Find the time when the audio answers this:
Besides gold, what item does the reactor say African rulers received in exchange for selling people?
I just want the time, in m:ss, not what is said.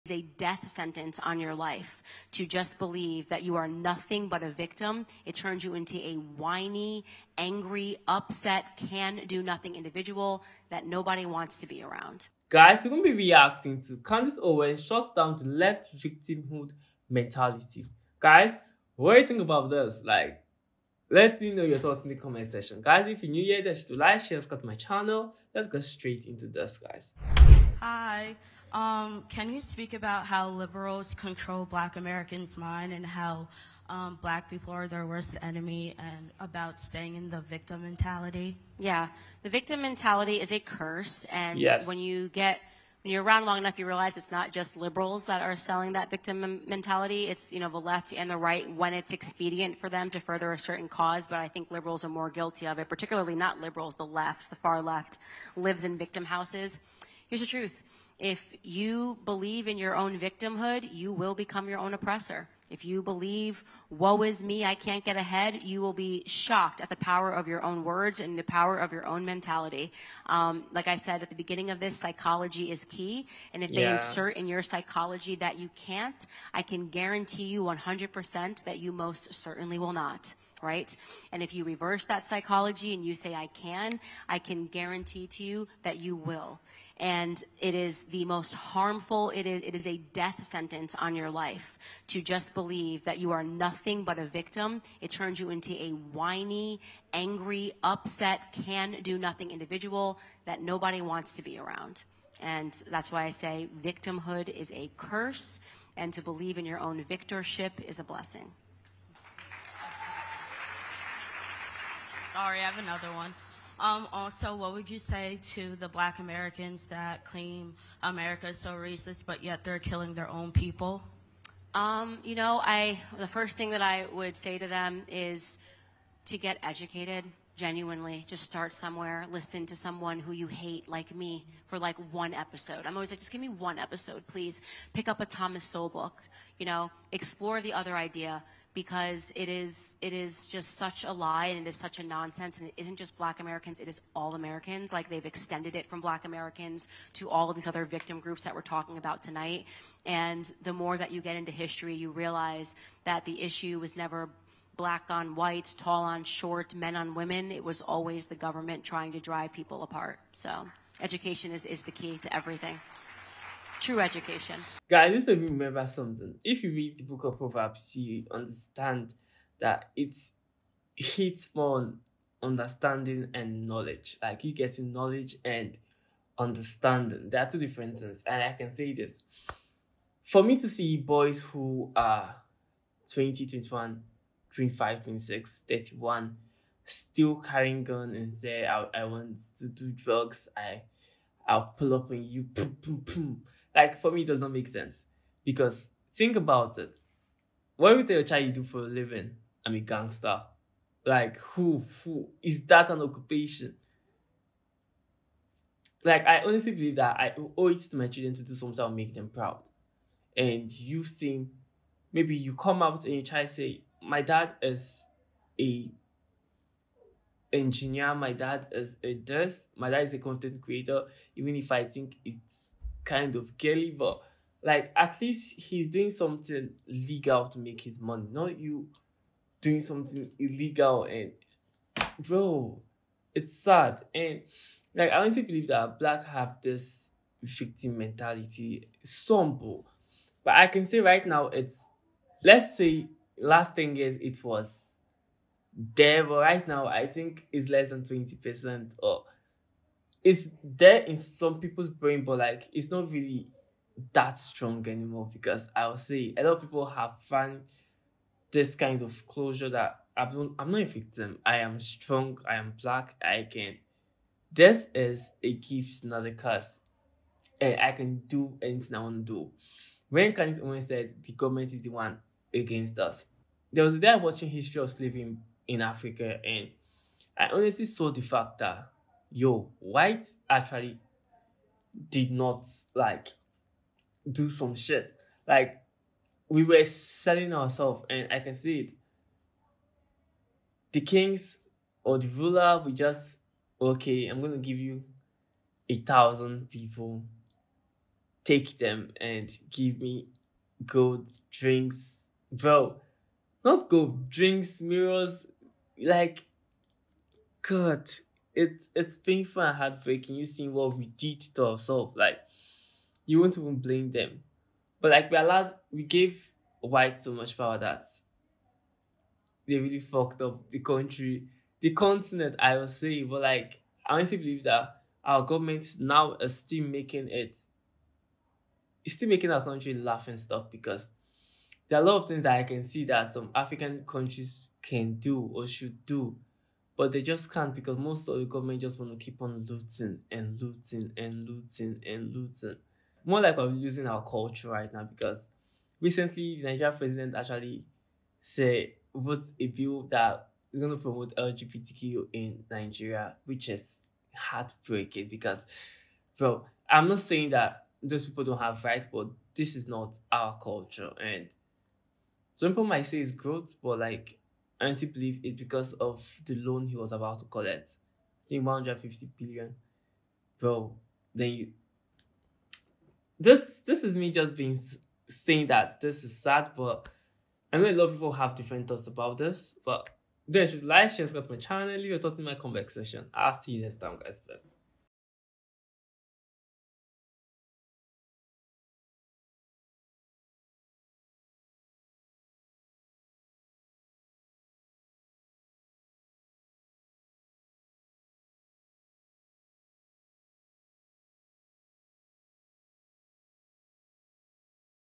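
5:04.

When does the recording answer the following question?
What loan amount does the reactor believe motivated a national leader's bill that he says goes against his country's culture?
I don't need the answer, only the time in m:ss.
6:08.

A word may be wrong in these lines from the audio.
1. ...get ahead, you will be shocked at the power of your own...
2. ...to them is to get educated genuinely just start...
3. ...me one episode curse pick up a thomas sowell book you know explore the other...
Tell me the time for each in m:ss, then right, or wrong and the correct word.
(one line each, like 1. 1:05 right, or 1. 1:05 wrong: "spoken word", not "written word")
1. 1:05 right
2. 2:04 right
3. 2:13 wrong: "please", not "curse".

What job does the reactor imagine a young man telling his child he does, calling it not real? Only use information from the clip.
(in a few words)
Gangster.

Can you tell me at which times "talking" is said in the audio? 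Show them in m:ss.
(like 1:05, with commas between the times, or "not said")
2:28, 6:22.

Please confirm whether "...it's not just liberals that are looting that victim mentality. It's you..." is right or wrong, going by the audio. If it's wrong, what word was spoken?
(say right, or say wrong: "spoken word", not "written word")
wrong: "selling", not "looting".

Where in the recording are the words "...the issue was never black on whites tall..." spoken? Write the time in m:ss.
2:33.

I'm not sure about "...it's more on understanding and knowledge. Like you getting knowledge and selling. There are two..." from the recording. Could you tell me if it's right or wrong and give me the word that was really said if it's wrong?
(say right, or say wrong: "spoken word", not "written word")
wrong: "understanding", not "selling".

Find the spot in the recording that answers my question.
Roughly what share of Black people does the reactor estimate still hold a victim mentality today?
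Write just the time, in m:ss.
4:07.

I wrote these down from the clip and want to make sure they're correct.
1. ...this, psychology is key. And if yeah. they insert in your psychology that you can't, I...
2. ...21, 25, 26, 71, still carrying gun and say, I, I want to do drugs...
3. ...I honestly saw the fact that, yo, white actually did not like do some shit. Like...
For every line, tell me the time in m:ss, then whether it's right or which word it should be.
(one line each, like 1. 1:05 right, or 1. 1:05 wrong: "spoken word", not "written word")
1. 1:11 right
2. 3:03 wrong: "31", not "71"
3. 4:37 right.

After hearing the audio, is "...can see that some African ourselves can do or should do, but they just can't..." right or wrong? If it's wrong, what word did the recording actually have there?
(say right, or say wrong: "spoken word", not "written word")
wrong: "countries", not "ourselves".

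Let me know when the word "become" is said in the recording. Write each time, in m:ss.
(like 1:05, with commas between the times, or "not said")
1:01.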